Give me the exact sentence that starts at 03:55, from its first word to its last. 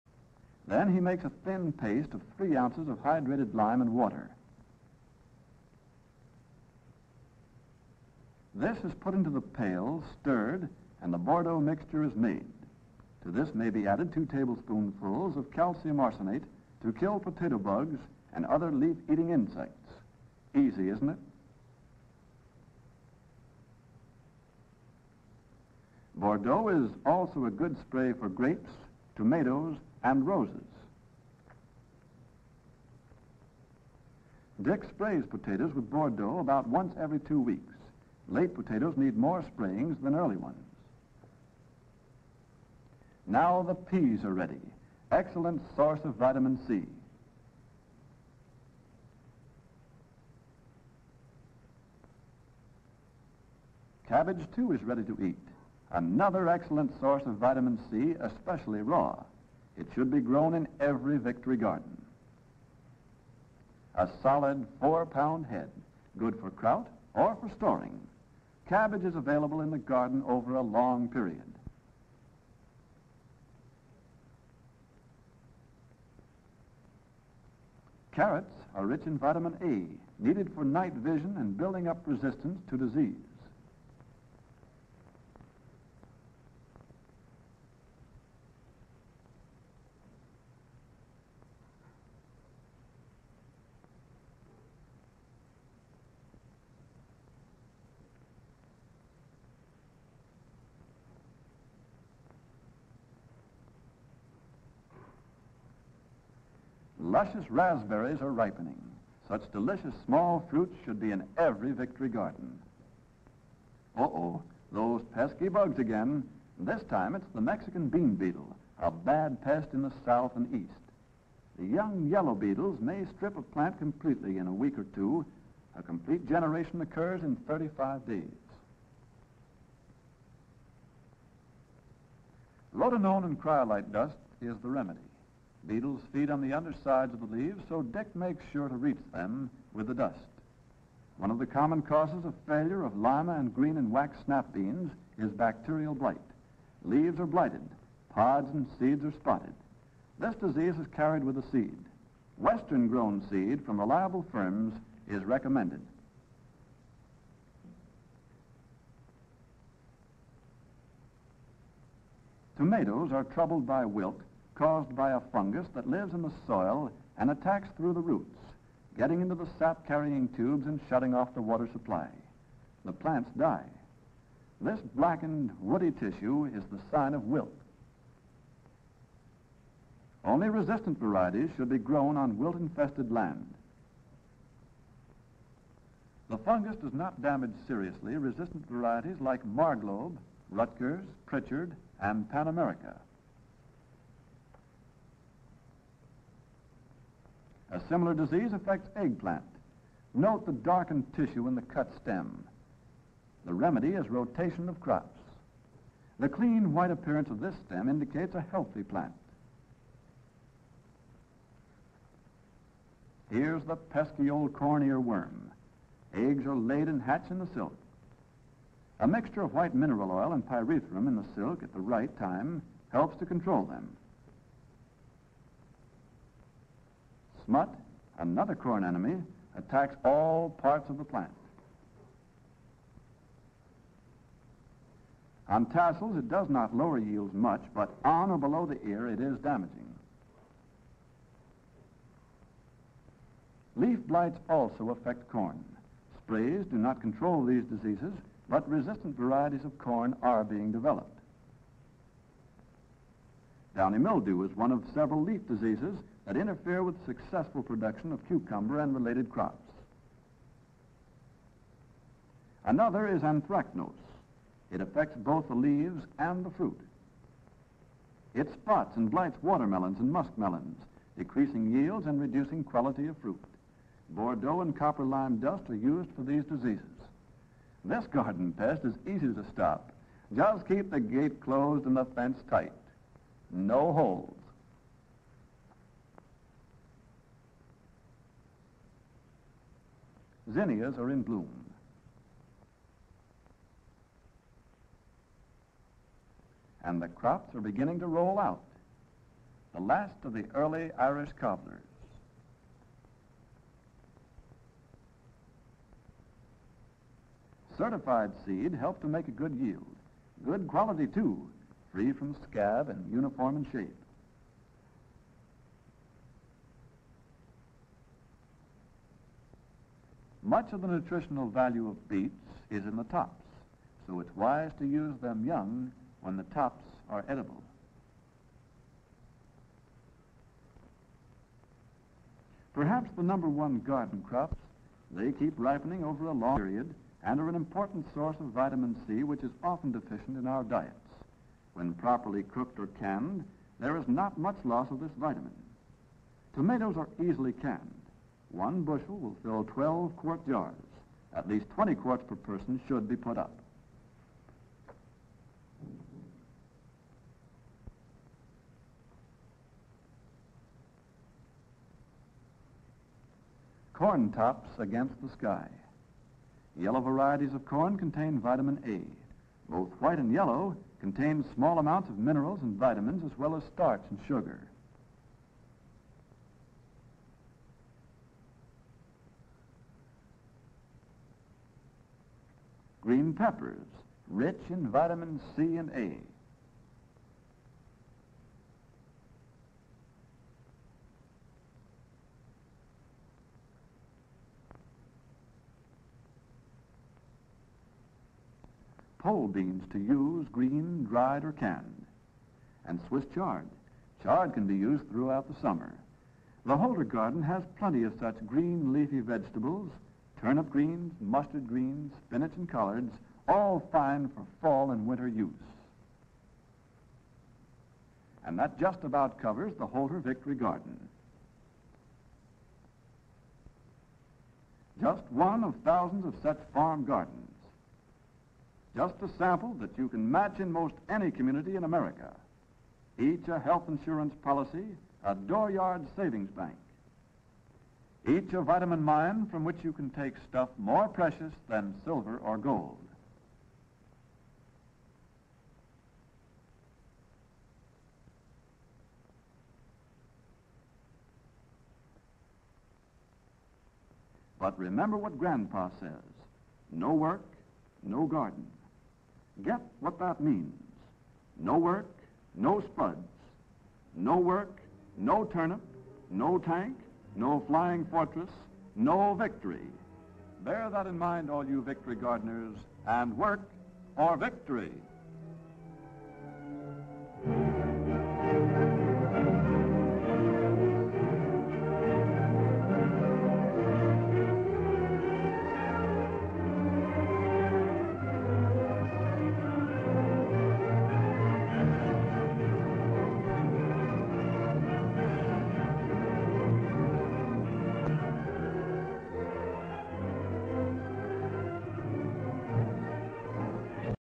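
On tassels, it does not lower yields much, but on or below the ear, it is damaging.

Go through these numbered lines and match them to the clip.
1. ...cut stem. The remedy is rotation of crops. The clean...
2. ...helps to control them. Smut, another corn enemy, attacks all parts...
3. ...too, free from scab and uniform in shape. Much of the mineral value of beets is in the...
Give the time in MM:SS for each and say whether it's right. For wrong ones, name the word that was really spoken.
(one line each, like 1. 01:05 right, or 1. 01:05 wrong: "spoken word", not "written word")
1. 03:21 right
2. 03:42 right
3. 05:11 wrong: "nutritional", not "mineral".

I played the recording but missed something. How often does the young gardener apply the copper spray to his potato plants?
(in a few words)
every two weeks.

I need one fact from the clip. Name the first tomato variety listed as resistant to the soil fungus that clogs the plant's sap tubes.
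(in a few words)
Marglobe.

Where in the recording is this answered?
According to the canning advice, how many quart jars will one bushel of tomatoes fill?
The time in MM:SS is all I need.
05:49.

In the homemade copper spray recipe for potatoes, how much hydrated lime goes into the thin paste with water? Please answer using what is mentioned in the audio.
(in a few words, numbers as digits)
3 ounces.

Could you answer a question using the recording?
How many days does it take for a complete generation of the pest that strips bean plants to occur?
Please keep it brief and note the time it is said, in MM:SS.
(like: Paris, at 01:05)
35, at 02:07.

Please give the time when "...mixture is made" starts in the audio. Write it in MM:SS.
00:11.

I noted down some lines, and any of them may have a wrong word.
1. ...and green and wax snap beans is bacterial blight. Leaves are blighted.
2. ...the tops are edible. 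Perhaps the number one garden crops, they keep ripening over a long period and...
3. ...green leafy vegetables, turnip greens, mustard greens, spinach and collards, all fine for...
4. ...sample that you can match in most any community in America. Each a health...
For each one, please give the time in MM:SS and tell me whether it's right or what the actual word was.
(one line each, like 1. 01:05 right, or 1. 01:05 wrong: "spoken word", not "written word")
1. 02:23 right
2. 05:26 right
3. 06:48 right
4. 07:09 right.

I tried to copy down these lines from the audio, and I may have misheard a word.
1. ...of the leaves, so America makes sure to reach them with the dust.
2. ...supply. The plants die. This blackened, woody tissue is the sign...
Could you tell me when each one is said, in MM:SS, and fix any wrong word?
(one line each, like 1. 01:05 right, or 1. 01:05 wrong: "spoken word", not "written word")
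1. 02:17 wrong: "Dick", not "America"
2. 02:51 right.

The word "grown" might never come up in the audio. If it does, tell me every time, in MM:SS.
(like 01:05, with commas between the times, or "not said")
01:00, 02:32, 03:01.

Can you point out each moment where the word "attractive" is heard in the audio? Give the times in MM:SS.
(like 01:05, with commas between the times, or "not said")
not said.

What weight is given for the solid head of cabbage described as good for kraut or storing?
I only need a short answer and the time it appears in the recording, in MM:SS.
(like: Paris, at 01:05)
4 pounds, at 01:04.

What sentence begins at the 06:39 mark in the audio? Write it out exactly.
pole beans to use, green, dried, or canned, and Swiss chard.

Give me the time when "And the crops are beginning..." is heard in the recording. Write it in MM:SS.
04:56.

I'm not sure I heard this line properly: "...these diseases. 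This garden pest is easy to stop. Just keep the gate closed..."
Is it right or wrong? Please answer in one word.
right.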